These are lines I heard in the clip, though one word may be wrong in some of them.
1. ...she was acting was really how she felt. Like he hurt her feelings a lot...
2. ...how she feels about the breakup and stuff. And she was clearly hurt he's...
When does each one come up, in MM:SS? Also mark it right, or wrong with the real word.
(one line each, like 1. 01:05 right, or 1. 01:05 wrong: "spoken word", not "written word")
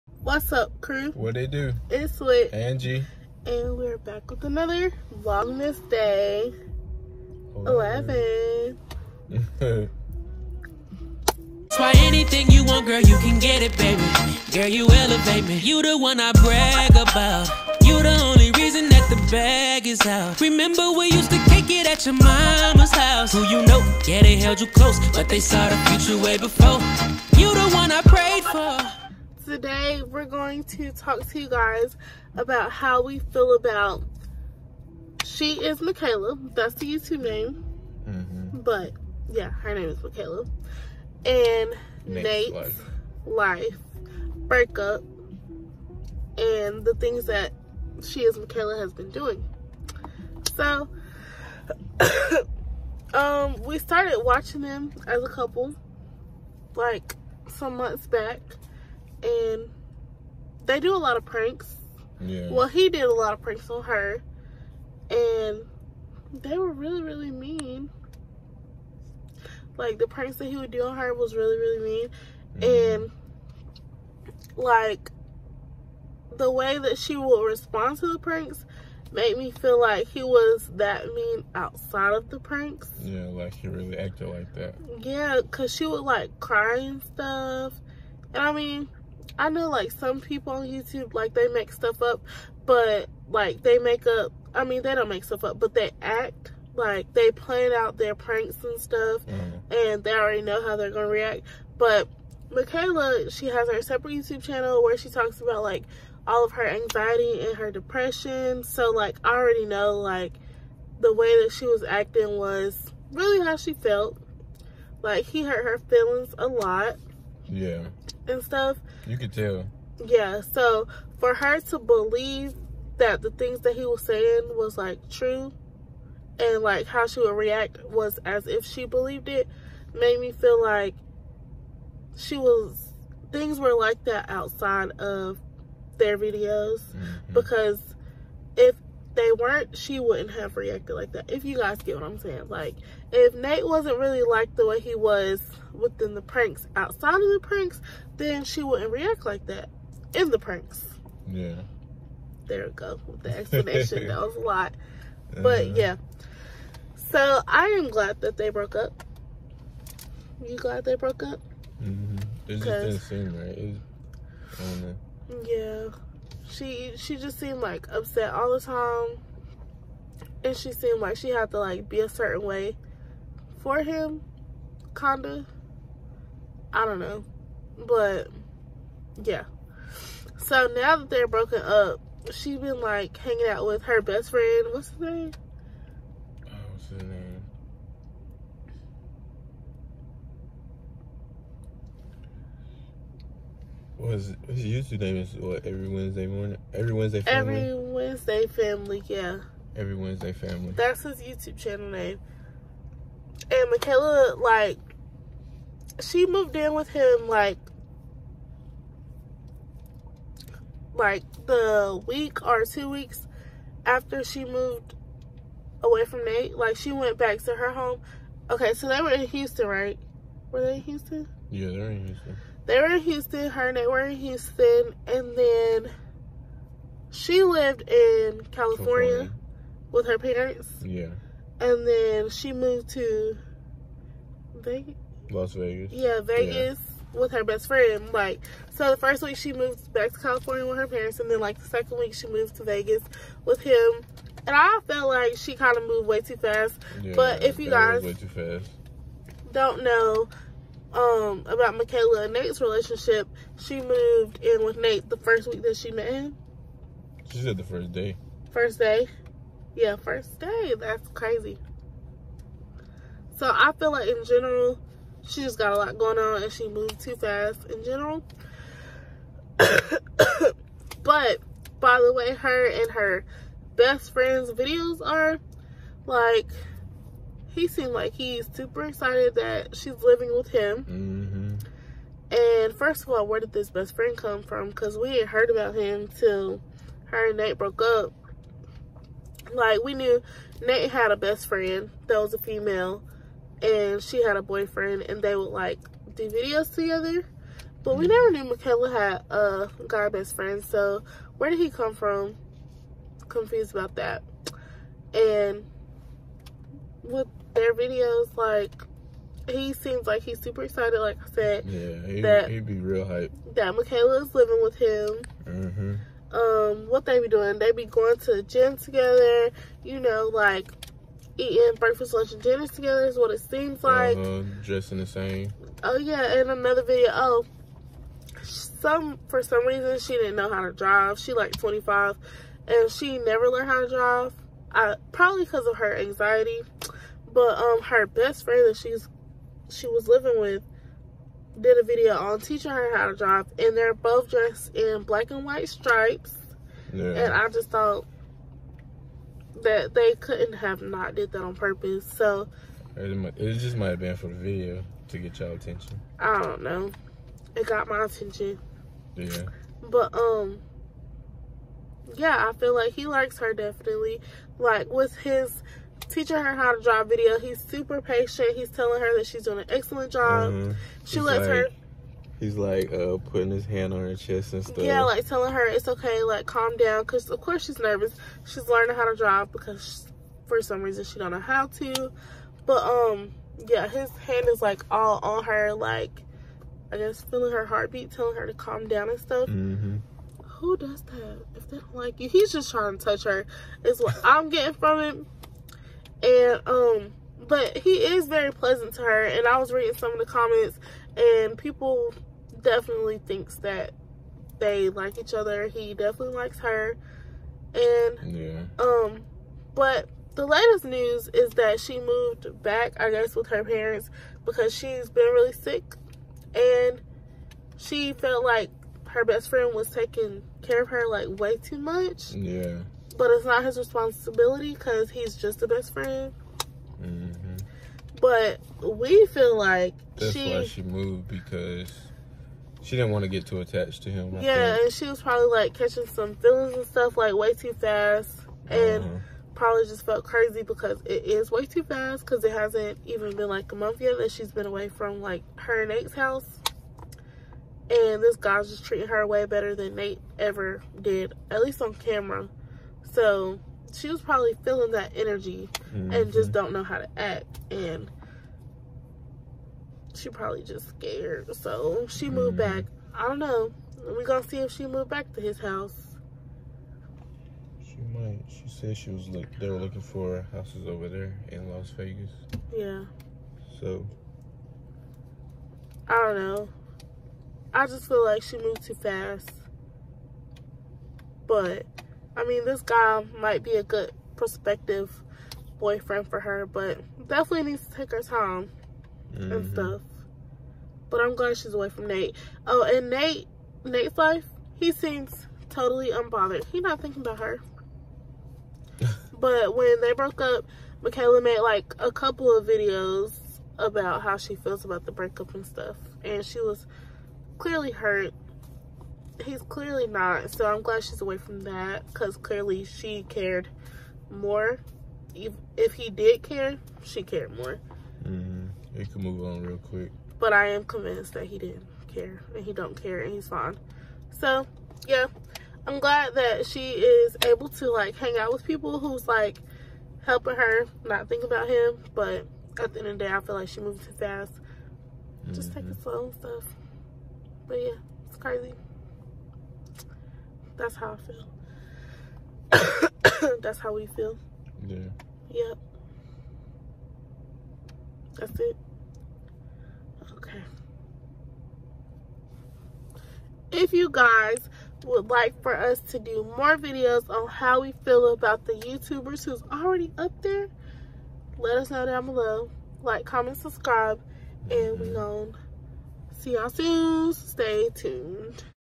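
1. 01:51 right
2. 08:24 right.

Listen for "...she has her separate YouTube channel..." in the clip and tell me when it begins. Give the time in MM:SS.
01:43.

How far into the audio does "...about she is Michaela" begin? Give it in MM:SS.
00:33.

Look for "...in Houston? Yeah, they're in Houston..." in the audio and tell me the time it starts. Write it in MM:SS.
03:40.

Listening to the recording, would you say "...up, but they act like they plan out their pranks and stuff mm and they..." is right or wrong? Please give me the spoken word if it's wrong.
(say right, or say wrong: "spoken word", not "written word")
right.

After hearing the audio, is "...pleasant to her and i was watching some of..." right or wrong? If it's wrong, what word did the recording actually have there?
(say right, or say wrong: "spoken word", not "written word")
wrong: "reading", not "watching".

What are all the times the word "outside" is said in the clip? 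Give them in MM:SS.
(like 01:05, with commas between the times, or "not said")
01:21, 02:14, 02:26.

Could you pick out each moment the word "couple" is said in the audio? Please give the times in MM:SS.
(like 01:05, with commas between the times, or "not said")
00:55, 08:22.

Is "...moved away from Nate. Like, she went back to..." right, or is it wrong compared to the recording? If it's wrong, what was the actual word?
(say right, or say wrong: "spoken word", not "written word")
right.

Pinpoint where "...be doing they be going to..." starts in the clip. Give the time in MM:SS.
05:17.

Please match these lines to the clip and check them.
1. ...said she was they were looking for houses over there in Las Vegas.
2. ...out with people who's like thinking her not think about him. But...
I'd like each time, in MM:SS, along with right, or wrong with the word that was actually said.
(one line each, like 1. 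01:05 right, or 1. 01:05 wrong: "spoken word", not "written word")
1. 07:48 right
2. 08:48 wrong: "helping", not "thinking".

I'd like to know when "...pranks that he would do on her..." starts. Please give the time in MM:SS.
01:10.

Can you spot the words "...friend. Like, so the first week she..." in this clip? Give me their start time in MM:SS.
03:57.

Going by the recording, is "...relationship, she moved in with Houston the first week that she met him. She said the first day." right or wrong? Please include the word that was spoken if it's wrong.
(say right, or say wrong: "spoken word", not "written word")
wrong: "Nate", not "Houston".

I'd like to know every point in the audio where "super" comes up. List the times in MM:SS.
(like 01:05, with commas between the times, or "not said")
04:38, 05:10, 06:07.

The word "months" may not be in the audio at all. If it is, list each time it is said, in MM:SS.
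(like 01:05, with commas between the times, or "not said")
00:57, 07:23.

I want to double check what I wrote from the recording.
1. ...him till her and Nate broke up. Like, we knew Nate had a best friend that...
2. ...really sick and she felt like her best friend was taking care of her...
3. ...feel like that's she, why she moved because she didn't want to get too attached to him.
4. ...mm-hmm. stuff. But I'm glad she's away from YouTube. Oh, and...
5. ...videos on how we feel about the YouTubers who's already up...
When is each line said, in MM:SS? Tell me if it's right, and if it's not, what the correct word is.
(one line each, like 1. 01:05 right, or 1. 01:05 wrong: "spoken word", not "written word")
1. 04:45 right
2. 06:55 right
3. 07:09 right
4. 08:09 wrong: "Nate", not "YouTube"
5. 09:16 right.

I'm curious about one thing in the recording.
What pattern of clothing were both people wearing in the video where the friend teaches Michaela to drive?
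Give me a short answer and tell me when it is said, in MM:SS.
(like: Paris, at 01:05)
Black and white stripes, at 05:45.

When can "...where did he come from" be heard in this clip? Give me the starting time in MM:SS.
05:01.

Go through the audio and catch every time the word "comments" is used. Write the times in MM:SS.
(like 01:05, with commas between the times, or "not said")
06:40, 09:23.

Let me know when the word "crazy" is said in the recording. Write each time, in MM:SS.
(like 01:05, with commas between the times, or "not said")
04:21, 07:20, 08:58.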